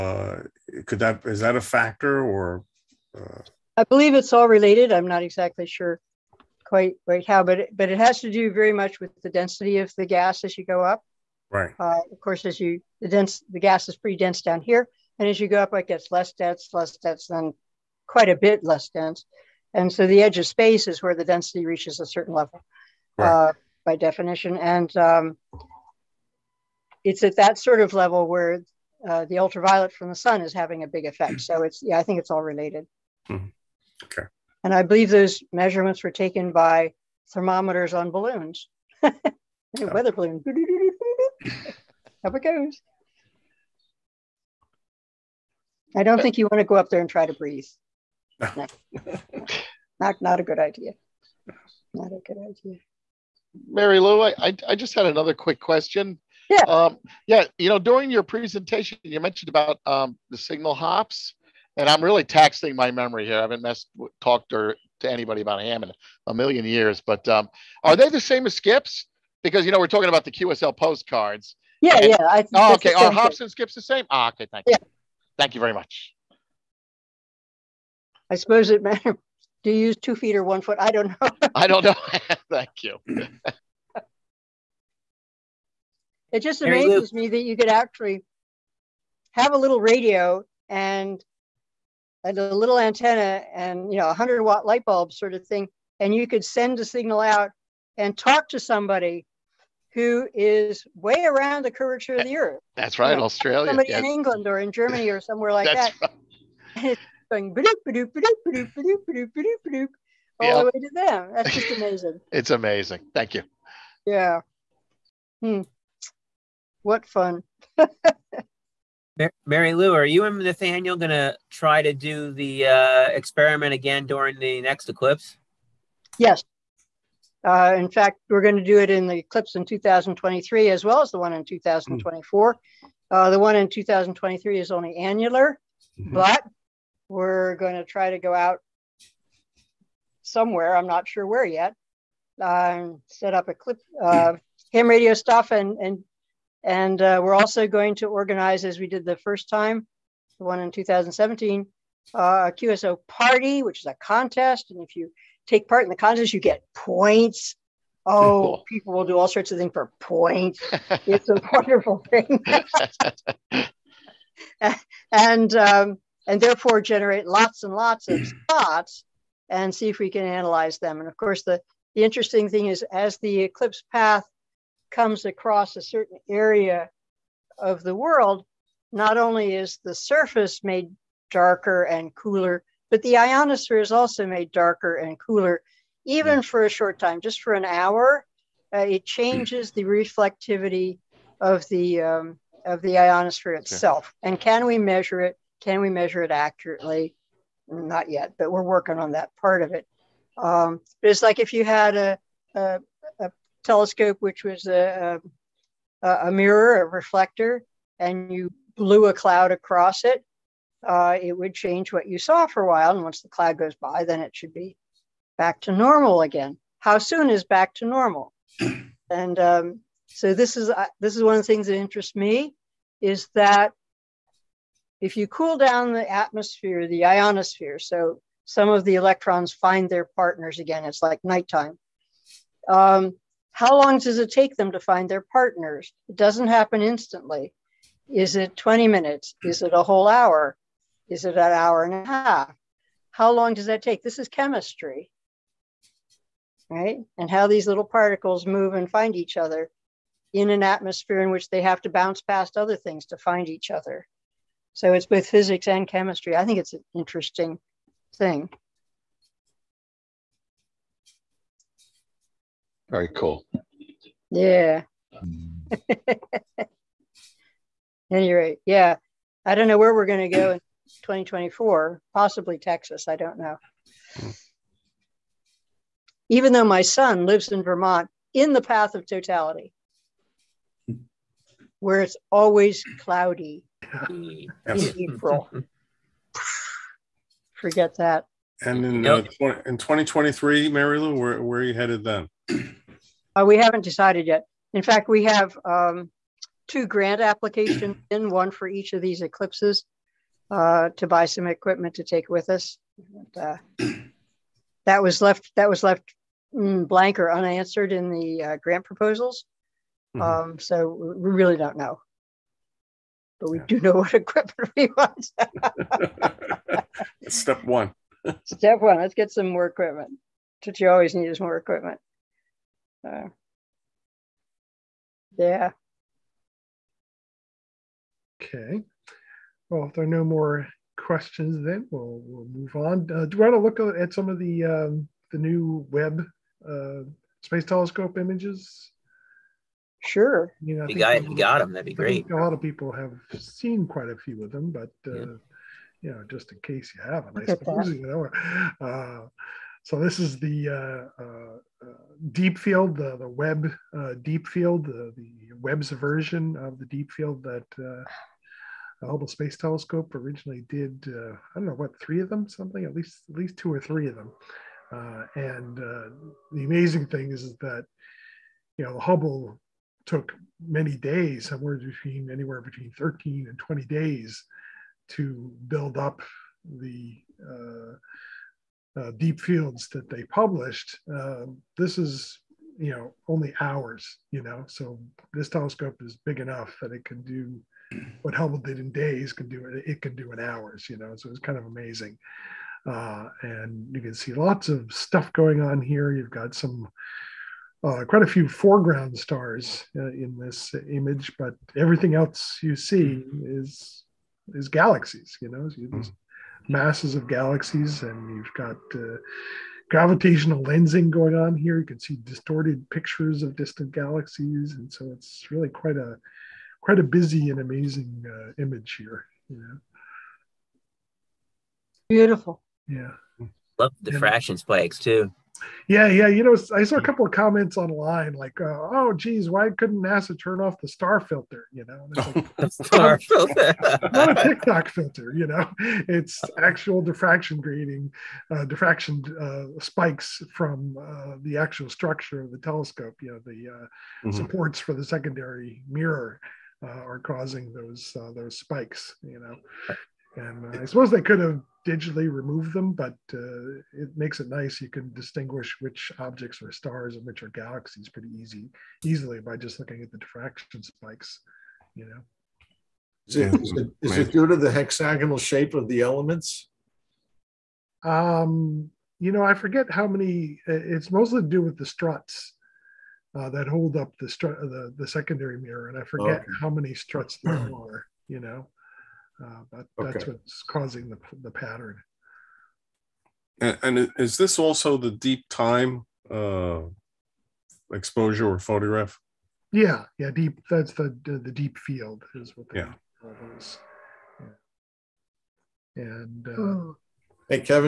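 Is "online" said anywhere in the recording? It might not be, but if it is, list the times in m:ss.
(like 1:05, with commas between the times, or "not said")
7:07.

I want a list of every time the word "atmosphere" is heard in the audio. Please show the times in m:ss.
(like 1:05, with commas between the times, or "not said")
3:46, 4:10.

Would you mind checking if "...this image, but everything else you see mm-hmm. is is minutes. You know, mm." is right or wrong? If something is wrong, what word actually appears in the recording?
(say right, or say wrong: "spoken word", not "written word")
wrong: "galaxies", not "minutes".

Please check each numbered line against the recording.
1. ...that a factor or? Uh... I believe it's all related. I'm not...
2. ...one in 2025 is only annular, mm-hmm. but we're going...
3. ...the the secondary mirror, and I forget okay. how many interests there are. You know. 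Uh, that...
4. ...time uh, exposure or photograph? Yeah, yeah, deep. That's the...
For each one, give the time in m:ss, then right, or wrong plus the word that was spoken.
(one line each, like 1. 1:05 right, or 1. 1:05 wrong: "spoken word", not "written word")
1. 0:01 right
2. 2:13 wrong: "2023", not "2025"
3. 7:54 wrong: "struts", not "interests"
4. 8:05 right.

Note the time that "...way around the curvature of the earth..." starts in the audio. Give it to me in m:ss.
1:40.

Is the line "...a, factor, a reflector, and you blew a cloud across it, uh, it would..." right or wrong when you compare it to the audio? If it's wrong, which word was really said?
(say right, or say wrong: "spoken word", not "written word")
wrong: "mirror", not "factor".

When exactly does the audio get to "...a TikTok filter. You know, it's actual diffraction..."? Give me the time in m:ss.
7:14.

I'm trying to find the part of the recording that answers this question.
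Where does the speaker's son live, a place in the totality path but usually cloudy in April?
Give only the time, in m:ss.
4:37.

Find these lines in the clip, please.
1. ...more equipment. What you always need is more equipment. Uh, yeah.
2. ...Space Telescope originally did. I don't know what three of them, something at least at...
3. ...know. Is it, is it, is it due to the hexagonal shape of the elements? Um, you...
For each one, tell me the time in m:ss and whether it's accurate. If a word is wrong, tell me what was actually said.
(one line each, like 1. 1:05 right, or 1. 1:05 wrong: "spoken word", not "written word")
1. 5:19 right
2. 5:59 right
3. 7:42 right.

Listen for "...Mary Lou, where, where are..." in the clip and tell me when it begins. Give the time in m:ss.
4:50.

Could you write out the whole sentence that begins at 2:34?
And if you take part in the contest, you get points.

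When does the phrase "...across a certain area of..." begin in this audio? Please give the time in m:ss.
2:55.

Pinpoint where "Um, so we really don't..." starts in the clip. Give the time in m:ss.
5:10.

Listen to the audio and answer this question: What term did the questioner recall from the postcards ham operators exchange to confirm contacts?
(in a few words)
QSL postcards.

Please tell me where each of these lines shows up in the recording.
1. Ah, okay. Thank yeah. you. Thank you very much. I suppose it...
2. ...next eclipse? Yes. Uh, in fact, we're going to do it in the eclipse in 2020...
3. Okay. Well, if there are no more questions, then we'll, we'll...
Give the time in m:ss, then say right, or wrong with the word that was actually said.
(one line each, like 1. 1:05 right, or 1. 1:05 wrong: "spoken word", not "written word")
1. 1:14 right
2. 2:04 wrong: "2023", not "2020"
3. 5:28 right.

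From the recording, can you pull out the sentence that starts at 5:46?
you know, just in case you haven't, I suppose you know.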